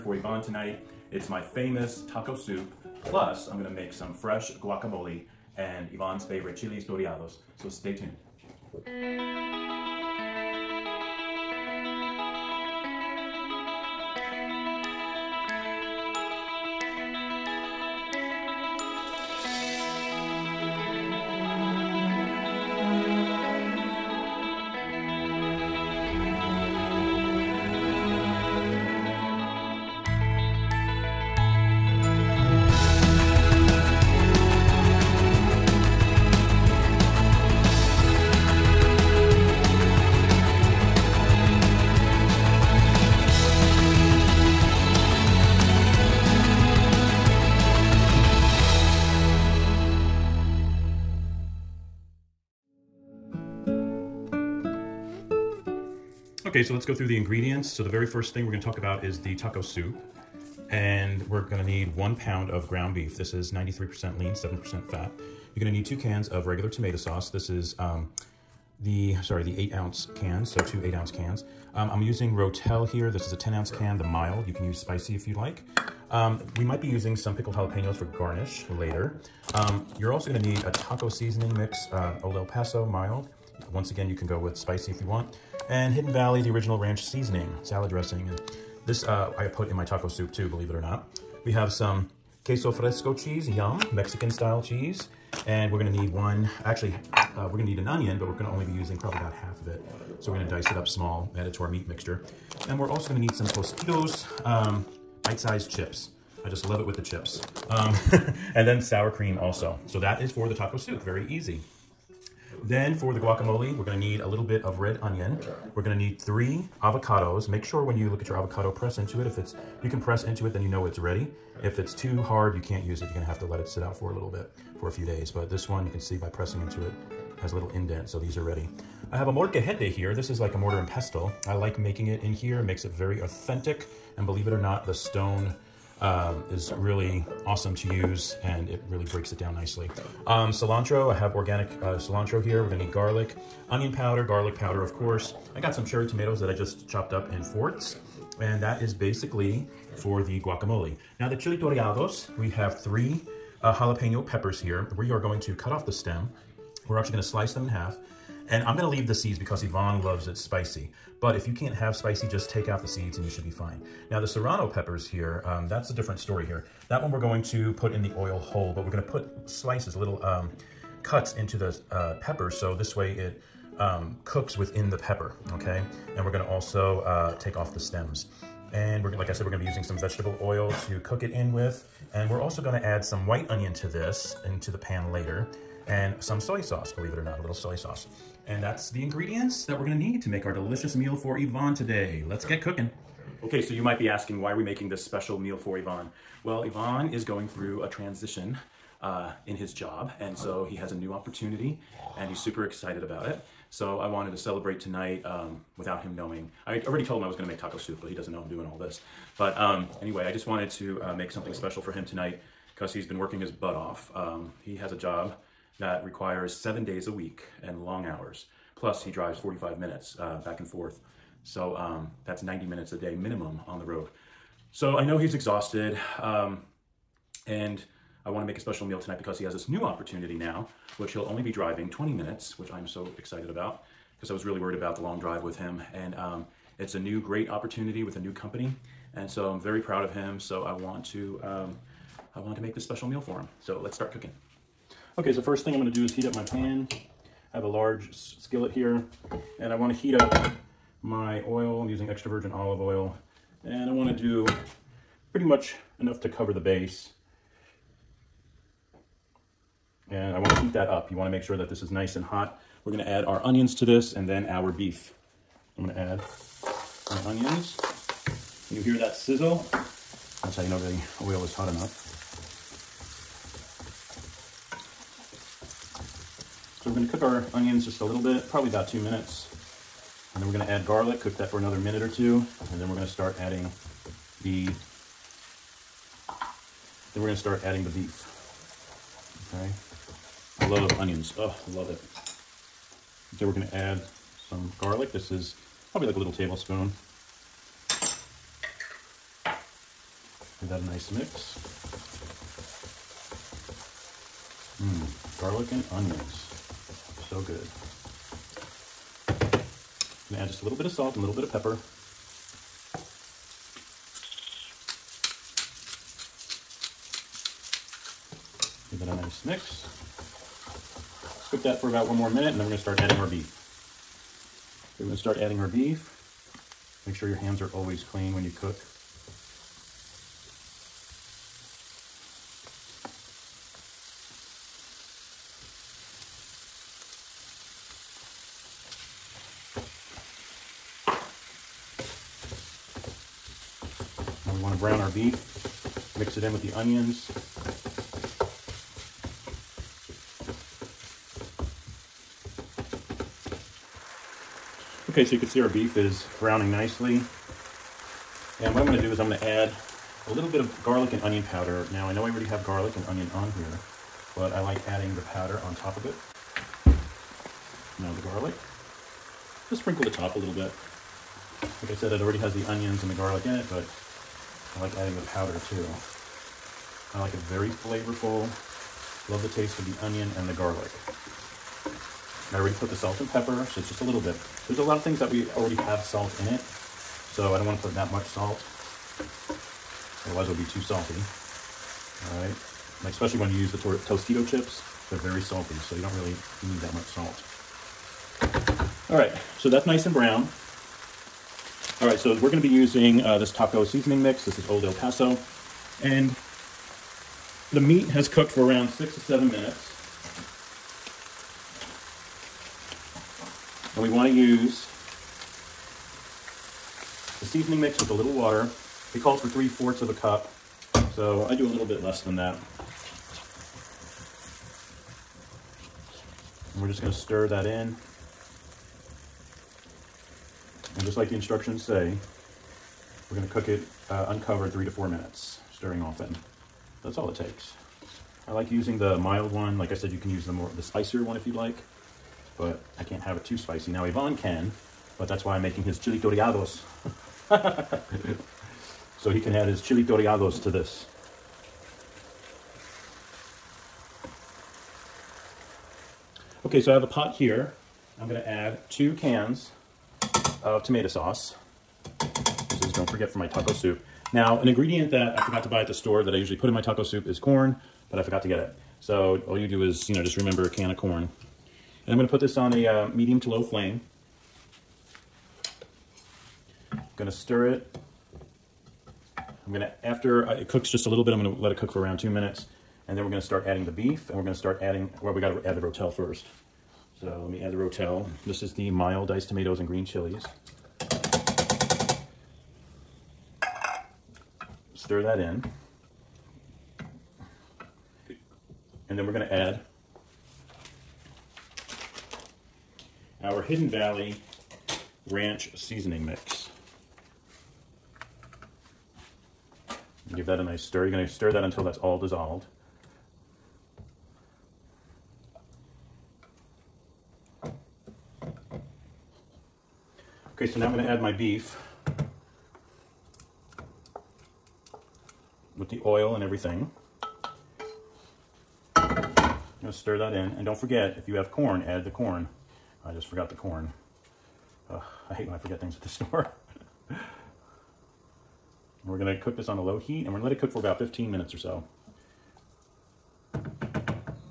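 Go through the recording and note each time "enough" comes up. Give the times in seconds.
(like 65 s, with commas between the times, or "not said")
255 s, 271 s.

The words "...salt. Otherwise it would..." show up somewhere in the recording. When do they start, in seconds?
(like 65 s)
388 s.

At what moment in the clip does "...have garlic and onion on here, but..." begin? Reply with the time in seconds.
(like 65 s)
362 s.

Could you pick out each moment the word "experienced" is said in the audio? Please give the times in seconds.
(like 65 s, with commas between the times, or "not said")
not said.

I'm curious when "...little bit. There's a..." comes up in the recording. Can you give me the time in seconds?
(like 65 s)
384 s.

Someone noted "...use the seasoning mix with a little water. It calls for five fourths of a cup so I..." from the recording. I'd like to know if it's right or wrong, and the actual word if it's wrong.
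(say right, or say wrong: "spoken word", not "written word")
wrong: "three", not "five".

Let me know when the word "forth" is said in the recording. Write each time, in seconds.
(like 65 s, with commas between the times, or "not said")
220 s.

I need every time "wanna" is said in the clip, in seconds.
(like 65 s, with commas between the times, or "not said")
249 s, 253 s.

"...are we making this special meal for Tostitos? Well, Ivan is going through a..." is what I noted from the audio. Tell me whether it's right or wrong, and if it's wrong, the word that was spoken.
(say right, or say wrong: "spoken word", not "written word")
wrong: "Ivan", not "Tostitos".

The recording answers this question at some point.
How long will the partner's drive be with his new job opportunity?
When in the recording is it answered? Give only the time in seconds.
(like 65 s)
231 s.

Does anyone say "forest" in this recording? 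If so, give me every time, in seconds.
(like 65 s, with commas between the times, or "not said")
not said.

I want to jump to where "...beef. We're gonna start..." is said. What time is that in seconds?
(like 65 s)
323 s.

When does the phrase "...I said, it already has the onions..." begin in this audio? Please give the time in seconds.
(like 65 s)
371 s.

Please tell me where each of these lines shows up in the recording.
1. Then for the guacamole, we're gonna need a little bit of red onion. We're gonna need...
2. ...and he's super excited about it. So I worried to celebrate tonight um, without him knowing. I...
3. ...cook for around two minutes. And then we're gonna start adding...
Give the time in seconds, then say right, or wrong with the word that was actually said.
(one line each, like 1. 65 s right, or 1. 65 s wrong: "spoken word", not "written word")
1. 112 s right
2. 202 s wrong: "wanted", not "worried"
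3. 481 s right.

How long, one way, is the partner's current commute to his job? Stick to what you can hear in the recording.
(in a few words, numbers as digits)
45 minutes.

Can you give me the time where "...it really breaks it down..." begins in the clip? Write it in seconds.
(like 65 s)
138 s.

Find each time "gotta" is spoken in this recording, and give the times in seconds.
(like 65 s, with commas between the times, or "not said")
485 s.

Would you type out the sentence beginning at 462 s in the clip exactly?
This is, don't forget, for my taco soup.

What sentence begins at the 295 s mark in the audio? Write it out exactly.
This is probably like a little tablespoon.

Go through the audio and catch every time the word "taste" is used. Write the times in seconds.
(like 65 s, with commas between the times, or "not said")
379 s.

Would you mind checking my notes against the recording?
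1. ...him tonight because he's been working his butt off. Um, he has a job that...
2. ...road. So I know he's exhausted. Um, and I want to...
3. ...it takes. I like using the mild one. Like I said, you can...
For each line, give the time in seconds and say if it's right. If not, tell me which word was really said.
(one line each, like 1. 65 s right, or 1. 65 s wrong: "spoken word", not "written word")
1. 211 s right
2. 223 s right
3. 437 s right.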